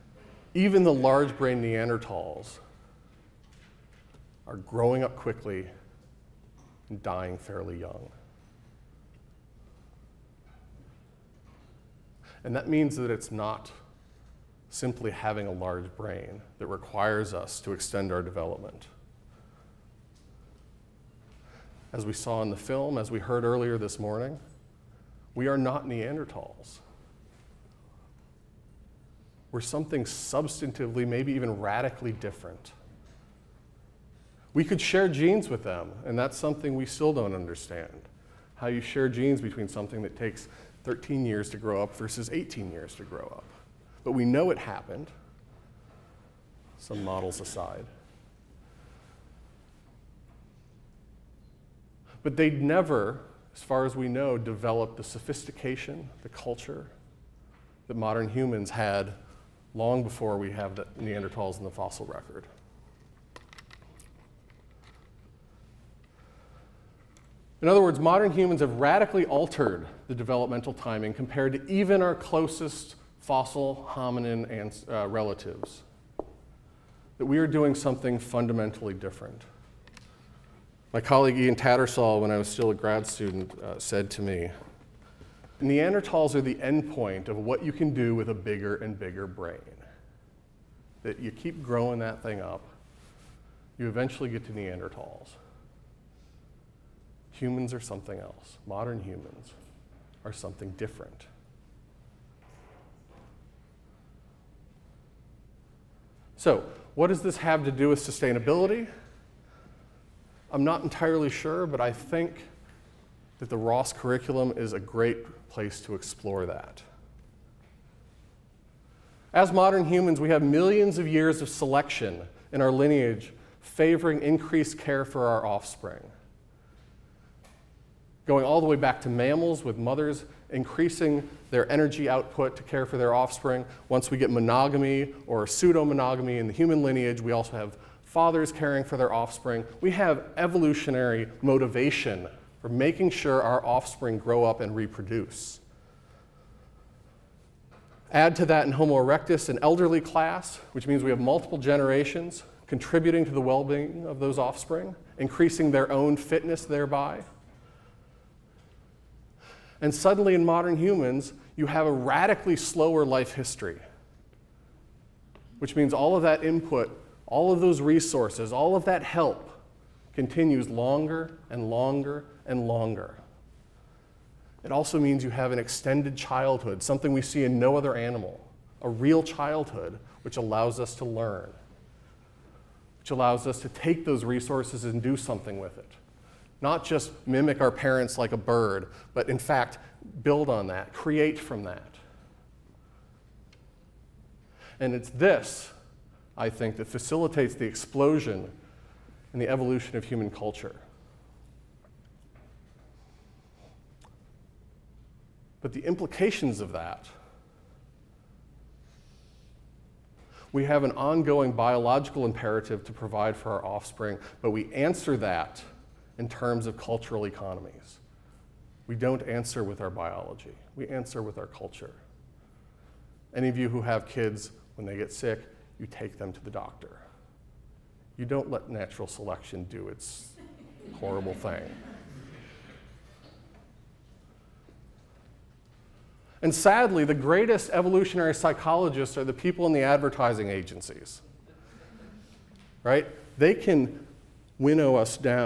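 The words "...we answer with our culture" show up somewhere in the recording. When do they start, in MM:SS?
03:40.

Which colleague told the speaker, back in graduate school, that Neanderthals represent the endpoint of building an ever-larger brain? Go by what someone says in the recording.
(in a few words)
Ian Tattersall.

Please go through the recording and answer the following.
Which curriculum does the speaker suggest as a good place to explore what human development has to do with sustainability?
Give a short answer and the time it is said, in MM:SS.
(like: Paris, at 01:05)
Ross curriculum, at 01:53.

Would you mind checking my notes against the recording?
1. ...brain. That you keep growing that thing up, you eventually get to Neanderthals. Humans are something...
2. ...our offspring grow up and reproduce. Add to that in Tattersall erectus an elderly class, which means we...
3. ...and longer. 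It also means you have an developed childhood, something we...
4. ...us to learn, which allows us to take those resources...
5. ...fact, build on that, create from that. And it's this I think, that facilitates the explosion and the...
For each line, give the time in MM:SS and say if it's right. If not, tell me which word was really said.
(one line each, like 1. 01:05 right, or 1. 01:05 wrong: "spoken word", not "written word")
1. 01:29 right
2. 02:23 wrong: "Homo", not "Tattersall"
3. 02:52 wrong: "extended", not "developed"
4. 03:00 right
5. 03:09 right.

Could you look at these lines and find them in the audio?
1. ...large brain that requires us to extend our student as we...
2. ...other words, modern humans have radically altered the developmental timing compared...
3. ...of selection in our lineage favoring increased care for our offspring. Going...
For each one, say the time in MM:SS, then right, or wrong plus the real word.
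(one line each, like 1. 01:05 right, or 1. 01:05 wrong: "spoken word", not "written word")
1. 00:15 wrong: "development", not "student"
2. 01:07 right
3. 02:01 right.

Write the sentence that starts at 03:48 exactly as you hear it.
You don't let natural selection do its horrible thing.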